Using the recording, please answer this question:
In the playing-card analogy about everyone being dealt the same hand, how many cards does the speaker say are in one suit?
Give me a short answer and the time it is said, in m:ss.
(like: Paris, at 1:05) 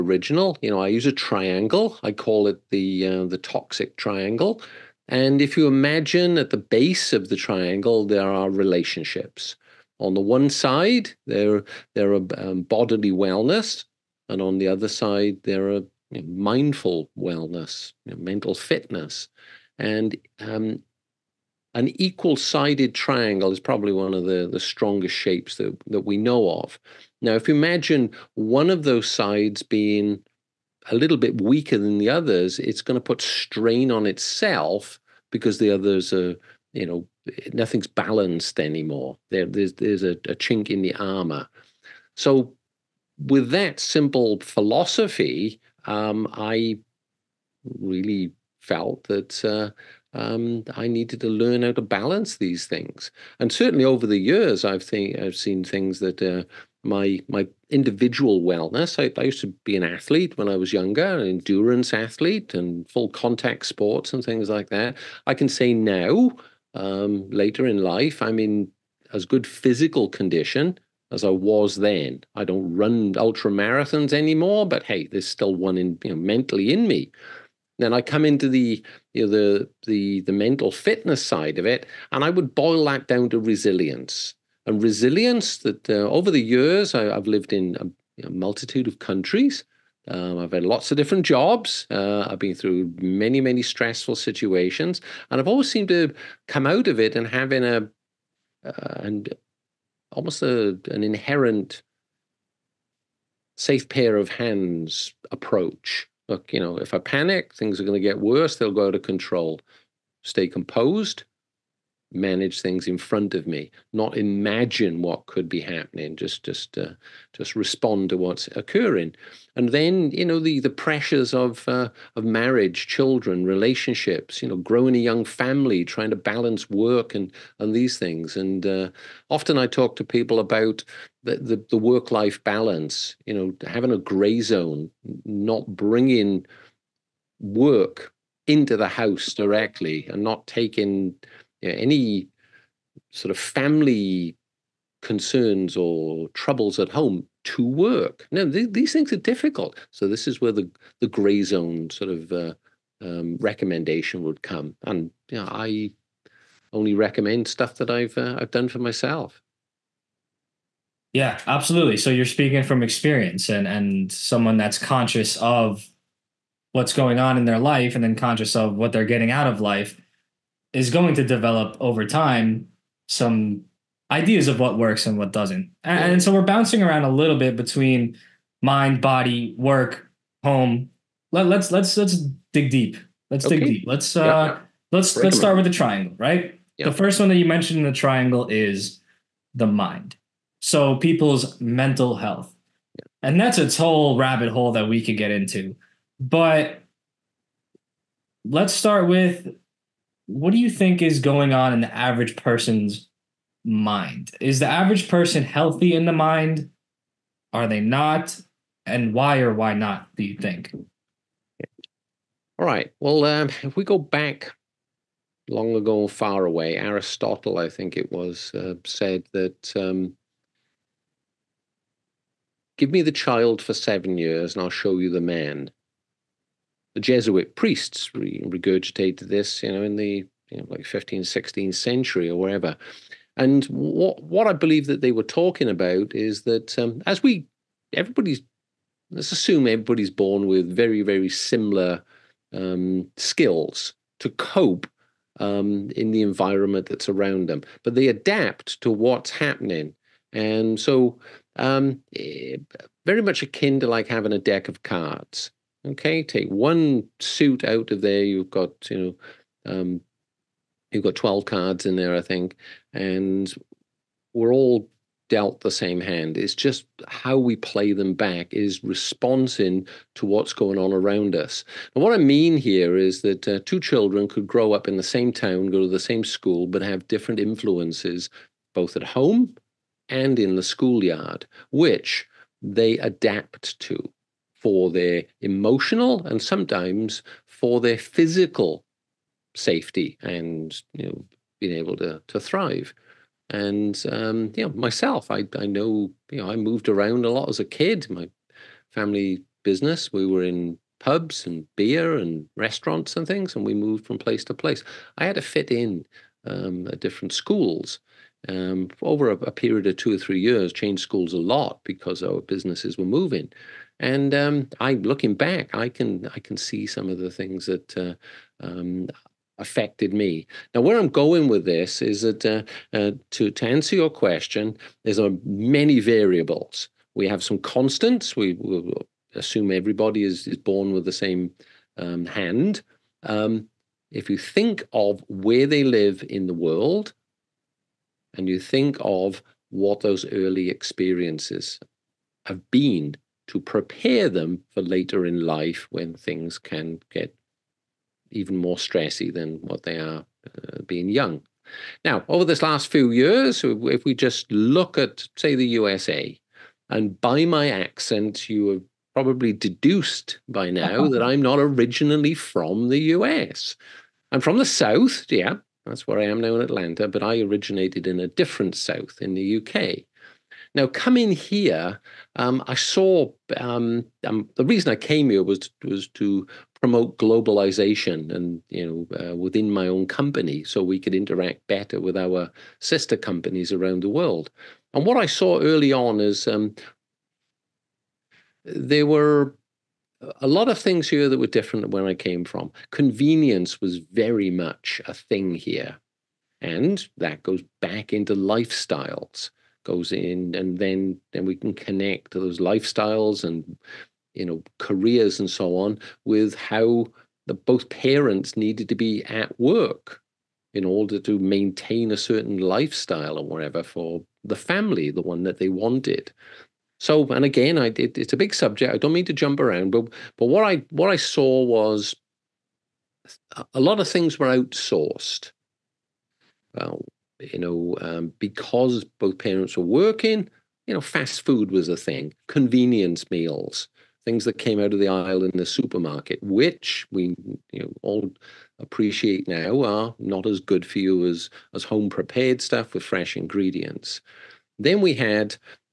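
12, at 4:21.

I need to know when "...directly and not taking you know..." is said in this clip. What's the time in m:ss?
2:19.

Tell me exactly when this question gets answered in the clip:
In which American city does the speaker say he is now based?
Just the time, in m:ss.
6:06.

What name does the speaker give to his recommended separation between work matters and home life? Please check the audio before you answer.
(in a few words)
Gray zone.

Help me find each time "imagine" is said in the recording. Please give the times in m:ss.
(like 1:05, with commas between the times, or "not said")
0:05, 0:27, 1:54.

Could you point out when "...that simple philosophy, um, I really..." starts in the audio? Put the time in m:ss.
0:43.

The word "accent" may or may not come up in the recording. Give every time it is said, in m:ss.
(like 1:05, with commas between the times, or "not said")
5:57.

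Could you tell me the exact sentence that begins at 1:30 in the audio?
Um, I've had lots of different jobs.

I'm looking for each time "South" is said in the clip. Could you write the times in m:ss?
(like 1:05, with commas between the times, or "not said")
6:04, 6:08.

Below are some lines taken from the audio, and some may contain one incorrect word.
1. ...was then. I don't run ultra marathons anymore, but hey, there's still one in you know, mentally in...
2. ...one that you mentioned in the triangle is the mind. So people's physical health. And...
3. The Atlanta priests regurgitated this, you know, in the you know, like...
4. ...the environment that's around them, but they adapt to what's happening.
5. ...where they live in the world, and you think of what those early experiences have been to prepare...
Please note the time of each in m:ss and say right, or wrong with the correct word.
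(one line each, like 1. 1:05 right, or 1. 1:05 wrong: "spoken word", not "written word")
1. 1:11 right
2. 3:07 wrong: "mental", not "physical"
3. 3:46 wrong: "Jesuit", not "Atlanta"
4. 4:06 right
5. 5:35 right.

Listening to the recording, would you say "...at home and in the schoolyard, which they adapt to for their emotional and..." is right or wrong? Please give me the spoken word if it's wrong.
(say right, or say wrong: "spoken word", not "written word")
right.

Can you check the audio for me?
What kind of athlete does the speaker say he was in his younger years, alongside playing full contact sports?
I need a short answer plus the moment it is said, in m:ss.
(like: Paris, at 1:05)
Endurance athlete, at 1:01.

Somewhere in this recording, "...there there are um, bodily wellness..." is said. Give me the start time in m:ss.
0:11.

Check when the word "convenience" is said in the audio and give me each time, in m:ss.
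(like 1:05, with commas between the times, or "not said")
6:32, 7:12.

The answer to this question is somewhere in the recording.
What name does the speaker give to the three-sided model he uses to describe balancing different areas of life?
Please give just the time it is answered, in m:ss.
0:03.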